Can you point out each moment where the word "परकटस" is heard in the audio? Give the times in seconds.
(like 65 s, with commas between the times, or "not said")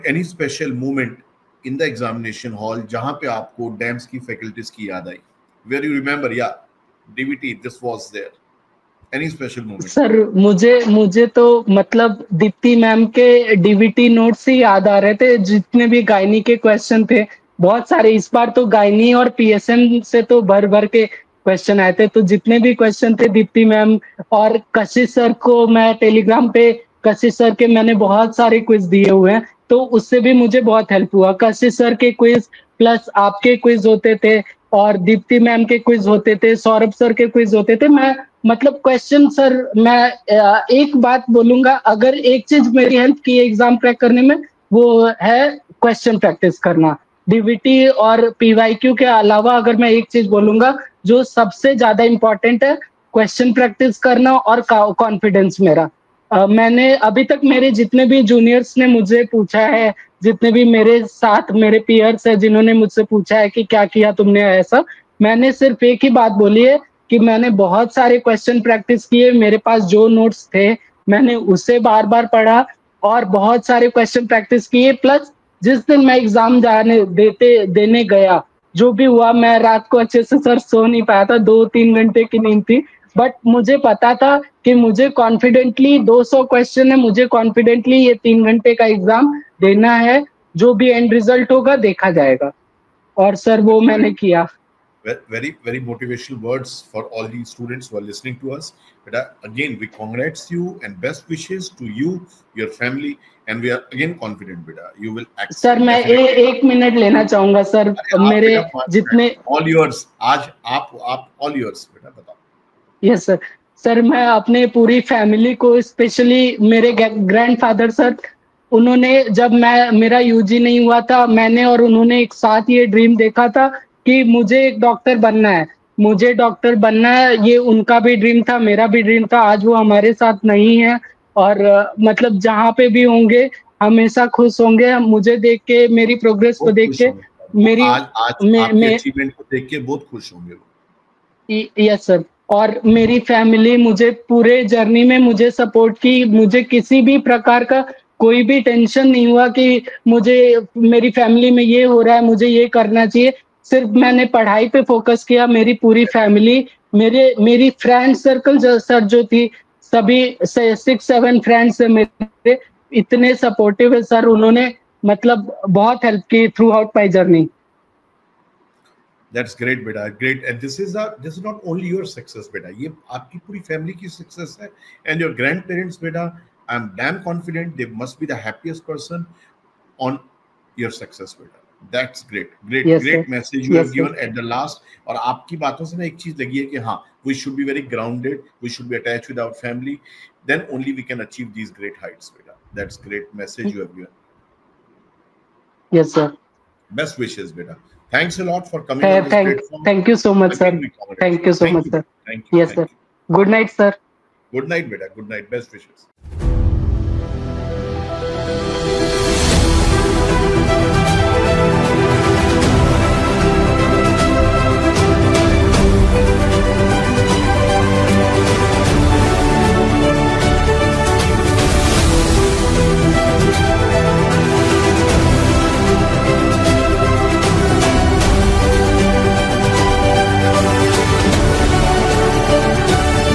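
46 s, 53 s, 68 s, 74 s.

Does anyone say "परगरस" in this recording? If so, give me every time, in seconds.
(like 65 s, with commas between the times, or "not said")
136 s.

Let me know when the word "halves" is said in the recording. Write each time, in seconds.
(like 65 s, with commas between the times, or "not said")
not said.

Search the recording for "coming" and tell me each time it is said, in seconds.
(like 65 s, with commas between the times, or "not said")
198 s.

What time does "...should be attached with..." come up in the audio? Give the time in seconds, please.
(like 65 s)
188 s.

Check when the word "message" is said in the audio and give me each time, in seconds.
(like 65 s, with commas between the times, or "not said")
183 s, 193 s.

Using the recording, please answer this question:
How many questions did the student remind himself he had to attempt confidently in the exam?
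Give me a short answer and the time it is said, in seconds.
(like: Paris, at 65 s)
200, at 86 s.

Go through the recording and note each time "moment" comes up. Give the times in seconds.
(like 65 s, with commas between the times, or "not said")
9 s.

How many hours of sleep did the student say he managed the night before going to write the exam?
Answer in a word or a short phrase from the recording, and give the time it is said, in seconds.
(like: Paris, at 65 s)
2-3 hours, at 81 s.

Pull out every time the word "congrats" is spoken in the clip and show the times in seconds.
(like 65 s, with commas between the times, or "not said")
99 s.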